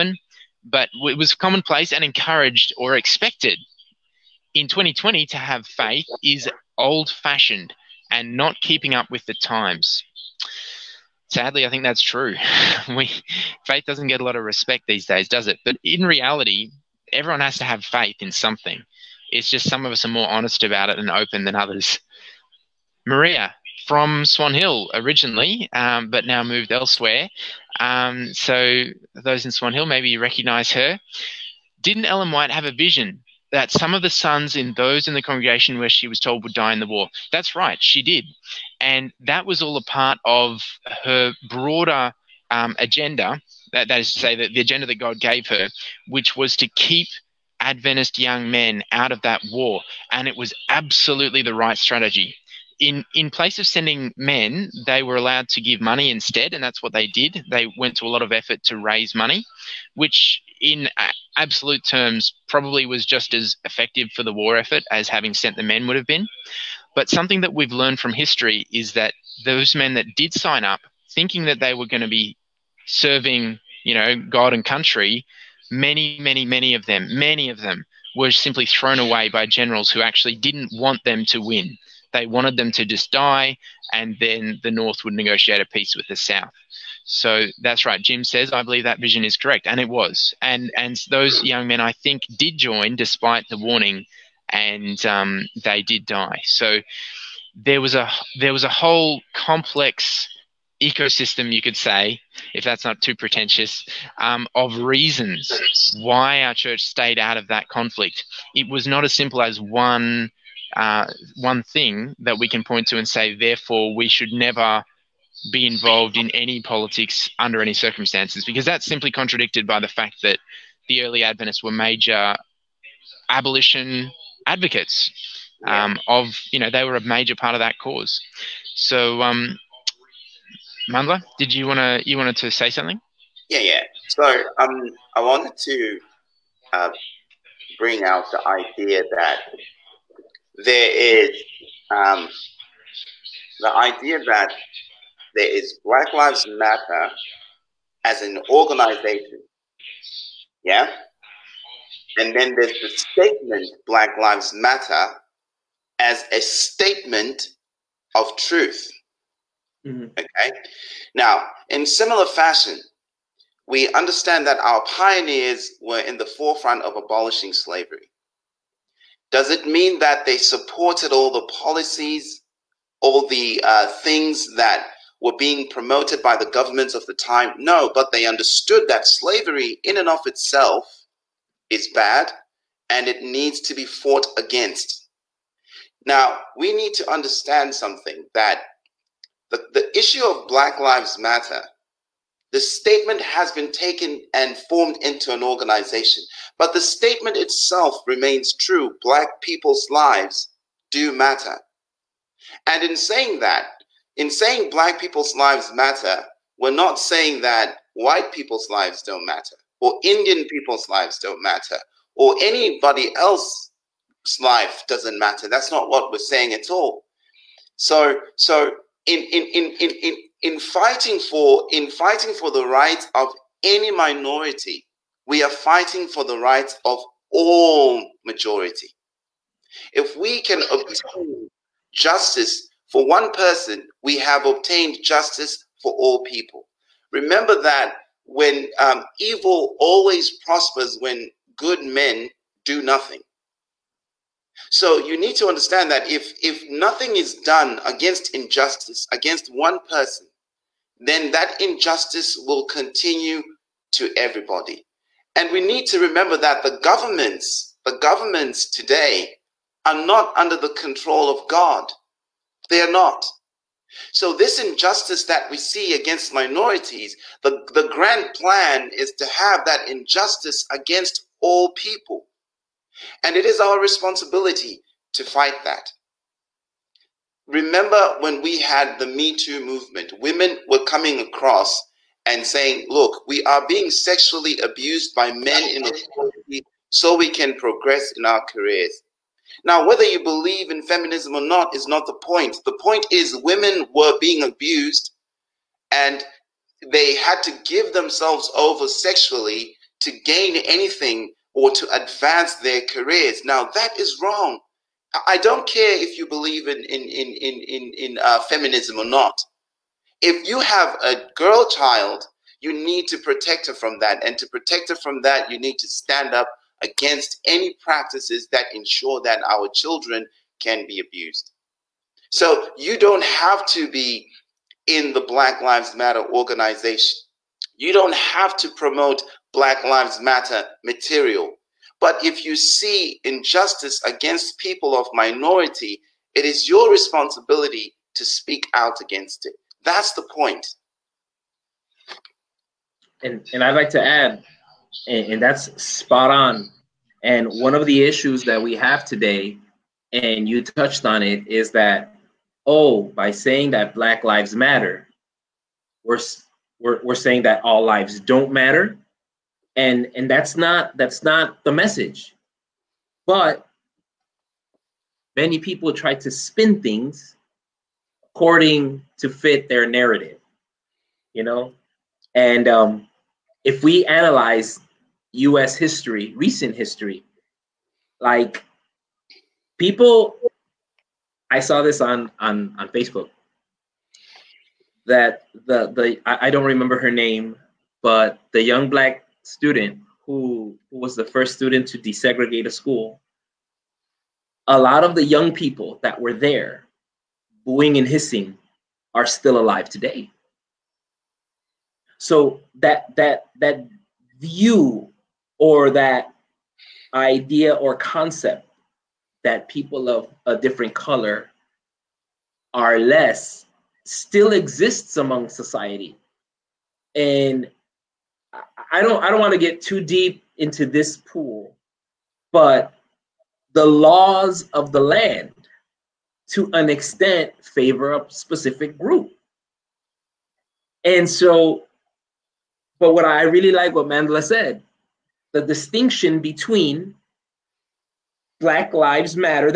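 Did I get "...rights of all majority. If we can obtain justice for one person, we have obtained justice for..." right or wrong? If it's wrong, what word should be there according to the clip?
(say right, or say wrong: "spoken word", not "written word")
right.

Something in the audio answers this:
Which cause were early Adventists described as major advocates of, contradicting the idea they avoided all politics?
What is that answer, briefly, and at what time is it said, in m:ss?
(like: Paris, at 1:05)
Abolition, at 2:03.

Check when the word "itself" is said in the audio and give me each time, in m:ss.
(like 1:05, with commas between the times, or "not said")
3:00, 3:17.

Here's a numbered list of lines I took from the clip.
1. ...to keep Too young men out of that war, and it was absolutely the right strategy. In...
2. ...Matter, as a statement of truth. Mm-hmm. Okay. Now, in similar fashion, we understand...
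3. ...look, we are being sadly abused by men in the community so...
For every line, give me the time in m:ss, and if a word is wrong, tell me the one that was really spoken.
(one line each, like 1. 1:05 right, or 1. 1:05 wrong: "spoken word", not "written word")
1. 0:46 wrong: "Adventist", not "Too"
2. 2:34 right
3. 4:42 wrong: "sexually", not "sadly".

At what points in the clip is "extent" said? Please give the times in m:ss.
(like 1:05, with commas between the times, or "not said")
7:06.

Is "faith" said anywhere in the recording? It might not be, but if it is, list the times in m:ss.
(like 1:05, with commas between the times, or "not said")
0:05, 0:13, 0:17.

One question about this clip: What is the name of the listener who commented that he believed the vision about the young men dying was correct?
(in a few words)
Jim.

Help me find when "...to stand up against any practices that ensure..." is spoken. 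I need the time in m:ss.
5:15.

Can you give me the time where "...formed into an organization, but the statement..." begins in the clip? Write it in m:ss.
3:14.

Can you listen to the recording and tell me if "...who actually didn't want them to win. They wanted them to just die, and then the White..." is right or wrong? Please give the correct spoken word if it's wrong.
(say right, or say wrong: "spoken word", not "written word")
wrong: "North", not "White".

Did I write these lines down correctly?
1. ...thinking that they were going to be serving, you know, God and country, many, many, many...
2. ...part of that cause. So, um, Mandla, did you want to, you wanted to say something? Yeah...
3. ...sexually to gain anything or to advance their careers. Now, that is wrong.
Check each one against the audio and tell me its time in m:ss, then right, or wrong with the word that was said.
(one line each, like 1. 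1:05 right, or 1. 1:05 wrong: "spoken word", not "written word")
1. 1:11 right
2. 2:07 right
3. 4:58 right.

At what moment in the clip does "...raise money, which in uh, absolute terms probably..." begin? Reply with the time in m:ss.
0:58.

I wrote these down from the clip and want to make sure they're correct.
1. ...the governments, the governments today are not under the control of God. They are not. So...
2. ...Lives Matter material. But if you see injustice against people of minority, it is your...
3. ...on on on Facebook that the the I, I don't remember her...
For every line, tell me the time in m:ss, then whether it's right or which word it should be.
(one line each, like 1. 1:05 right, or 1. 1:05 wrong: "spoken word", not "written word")
1. 4:16 right
2. 5:29 right
3. 6:22 right.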